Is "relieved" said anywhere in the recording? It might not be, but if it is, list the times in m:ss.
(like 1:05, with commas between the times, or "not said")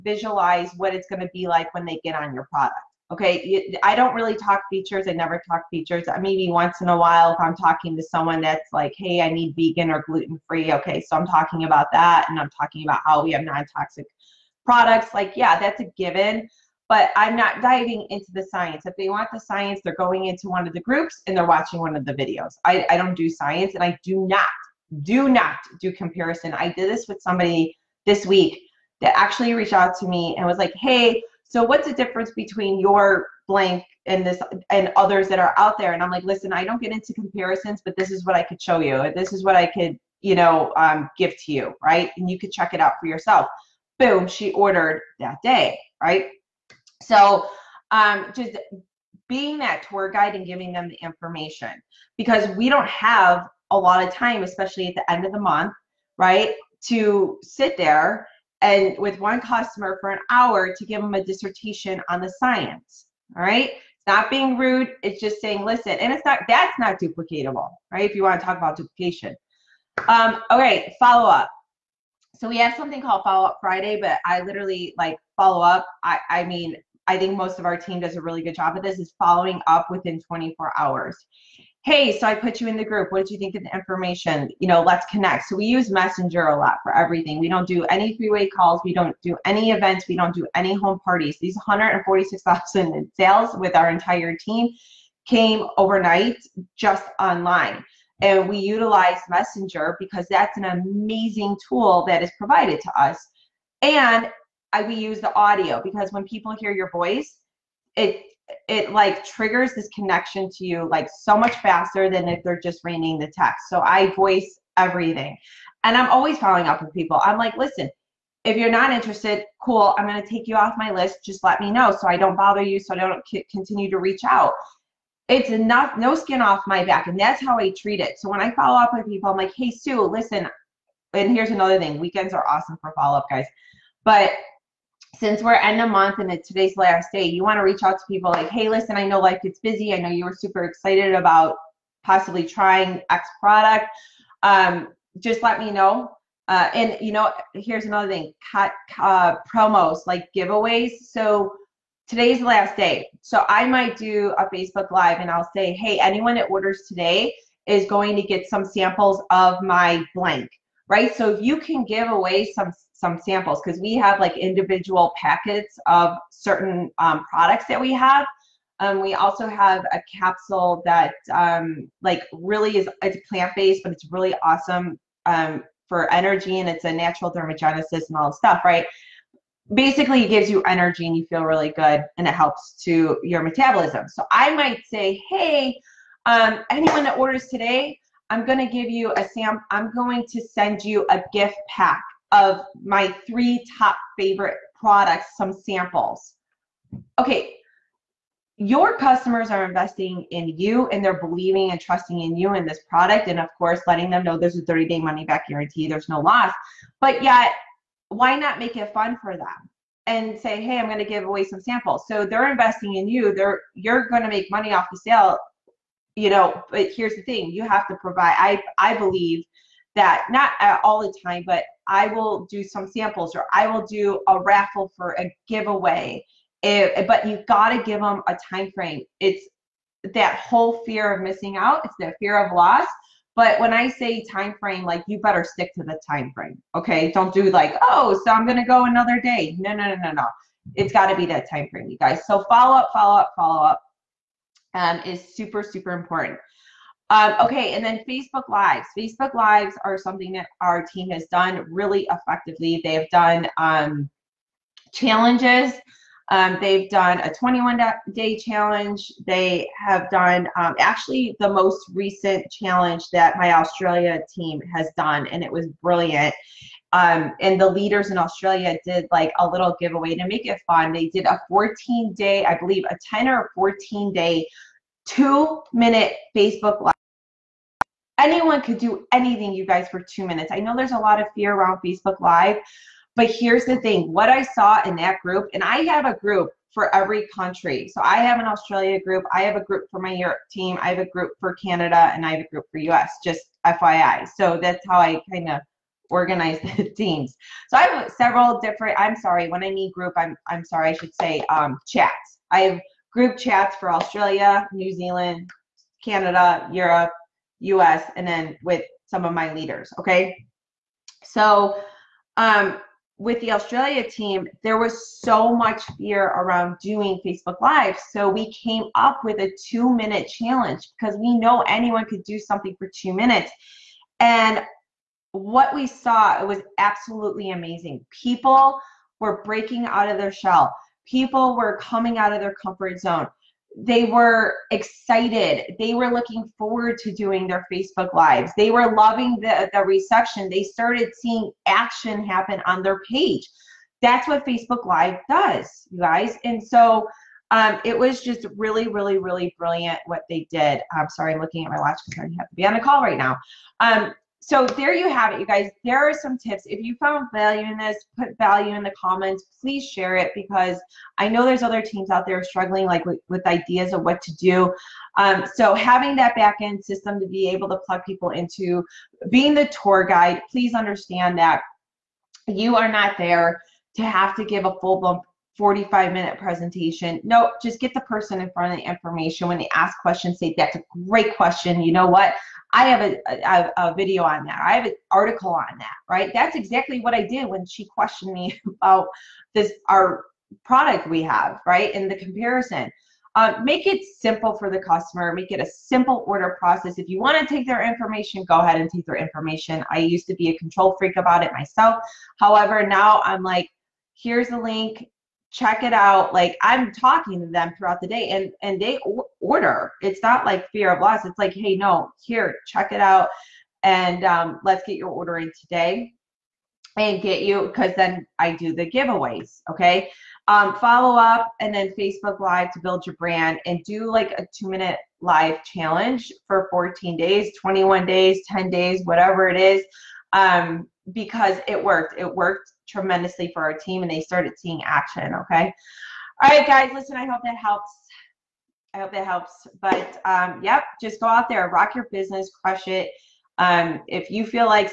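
not said.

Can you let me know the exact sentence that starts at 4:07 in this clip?
Um, okay, and then Facebook Lives.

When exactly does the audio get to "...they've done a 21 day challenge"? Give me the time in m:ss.
4:16.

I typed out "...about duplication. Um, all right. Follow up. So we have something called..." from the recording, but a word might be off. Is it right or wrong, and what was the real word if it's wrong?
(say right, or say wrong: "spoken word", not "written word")
right.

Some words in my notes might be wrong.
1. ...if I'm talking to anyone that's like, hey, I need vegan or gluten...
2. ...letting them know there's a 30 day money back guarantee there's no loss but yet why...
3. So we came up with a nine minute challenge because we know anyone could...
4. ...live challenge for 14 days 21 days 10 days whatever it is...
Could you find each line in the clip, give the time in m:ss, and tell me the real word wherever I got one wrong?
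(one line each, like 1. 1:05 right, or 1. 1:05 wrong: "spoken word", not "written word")
1. 0:07 wrong: "someone", not "anyone"
2. 3:23 right
3. 5:18 wrong: "two", not "nine"
4. 7:05 right.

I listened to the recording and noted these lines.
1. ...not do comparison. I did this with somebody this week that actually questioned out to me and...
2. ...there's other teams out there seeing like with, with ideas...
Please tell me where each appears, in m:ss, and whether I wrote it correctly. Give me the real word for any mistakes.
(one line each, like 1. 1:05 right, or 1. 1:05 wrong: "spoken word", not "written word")
1. 0:25 wrong: "reached", not "questioned"
2. 6:01 wrong: "struggling", not "seeing".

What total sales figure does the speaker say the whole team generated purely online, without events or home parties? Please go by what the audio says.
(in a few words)
146,000.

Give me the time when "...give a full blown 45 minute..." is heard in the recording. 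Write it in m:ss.
6:14.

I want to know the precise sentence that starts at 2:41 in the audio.
So if you can give away some some samples, because we have like individual packets of certain um, products that we have.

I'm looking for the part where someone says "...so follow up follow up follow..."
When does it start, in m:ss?
4:02.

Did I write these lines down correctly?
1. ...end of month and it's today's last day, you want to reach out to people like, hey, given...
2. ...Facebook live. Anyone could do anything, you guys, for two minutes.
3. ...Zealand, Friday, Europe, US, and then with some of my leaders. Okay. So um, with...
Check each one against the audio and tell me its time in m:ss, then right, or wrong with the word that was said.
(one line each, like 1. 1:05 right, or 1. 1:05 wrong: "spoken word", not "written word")
1. 2:15 wrong: "listen", not "given"
2. 4:36 right
3. 5:04 wrong: "Canada", not "Friday".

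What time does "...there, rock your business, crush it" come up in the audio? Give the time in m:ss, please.
7:21.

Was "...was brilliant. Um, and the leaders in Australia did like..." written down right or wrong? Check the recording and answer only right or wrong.
right.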